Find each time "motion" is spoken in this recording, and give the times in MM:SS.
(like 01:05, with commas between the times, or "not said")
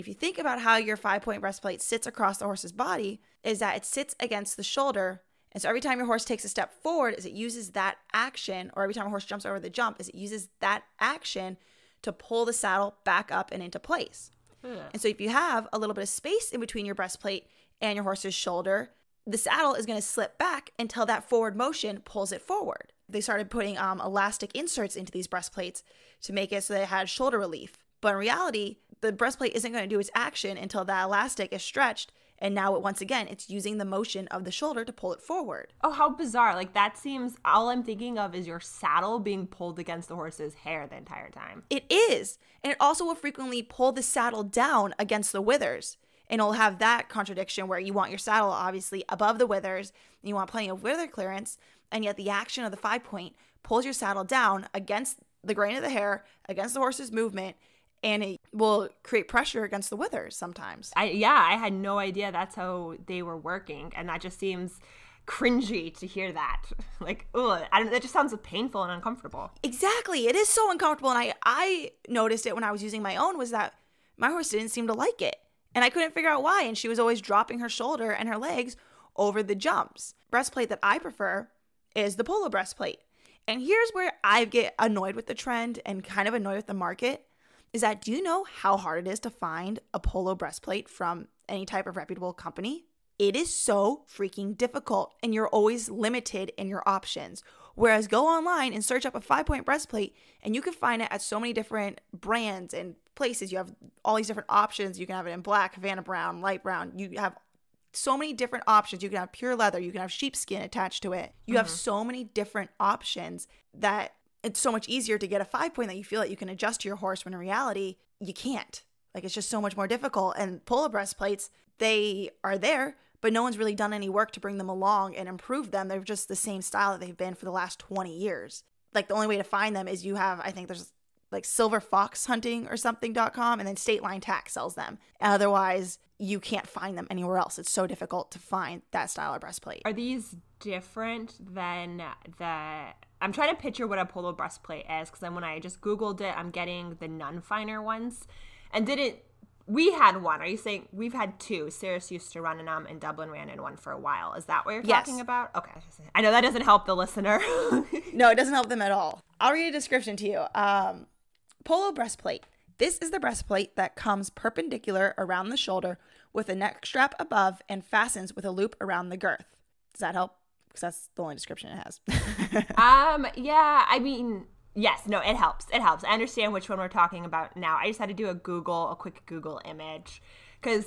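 00:21, 00:33.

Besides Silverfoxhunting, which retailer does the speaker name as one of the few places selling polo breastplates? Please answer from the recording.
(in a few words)
State Line Tack.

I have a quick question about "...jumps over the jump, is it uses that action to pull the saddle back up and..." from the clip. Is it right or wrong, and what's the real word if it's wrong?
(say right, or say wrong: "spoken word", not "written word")
right.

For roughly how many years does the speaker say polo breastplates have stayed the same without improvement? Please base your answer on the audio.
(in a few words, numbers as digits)
20.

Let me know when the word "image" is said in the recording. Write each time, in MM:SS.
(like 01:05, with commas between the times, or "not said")
02:59.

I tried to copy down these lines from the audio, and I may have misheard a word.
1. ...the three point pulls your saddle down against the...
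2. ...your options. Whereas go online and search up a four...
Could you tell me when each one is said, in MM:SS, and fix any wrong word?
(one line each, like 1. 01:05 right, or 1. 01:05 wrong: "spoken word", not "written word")
1. 00:52 wrong: "five", not "three"
2. 01:36 wrong: "five", not "four".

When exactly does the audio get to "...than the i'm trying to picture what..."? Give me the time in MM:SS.
02:21.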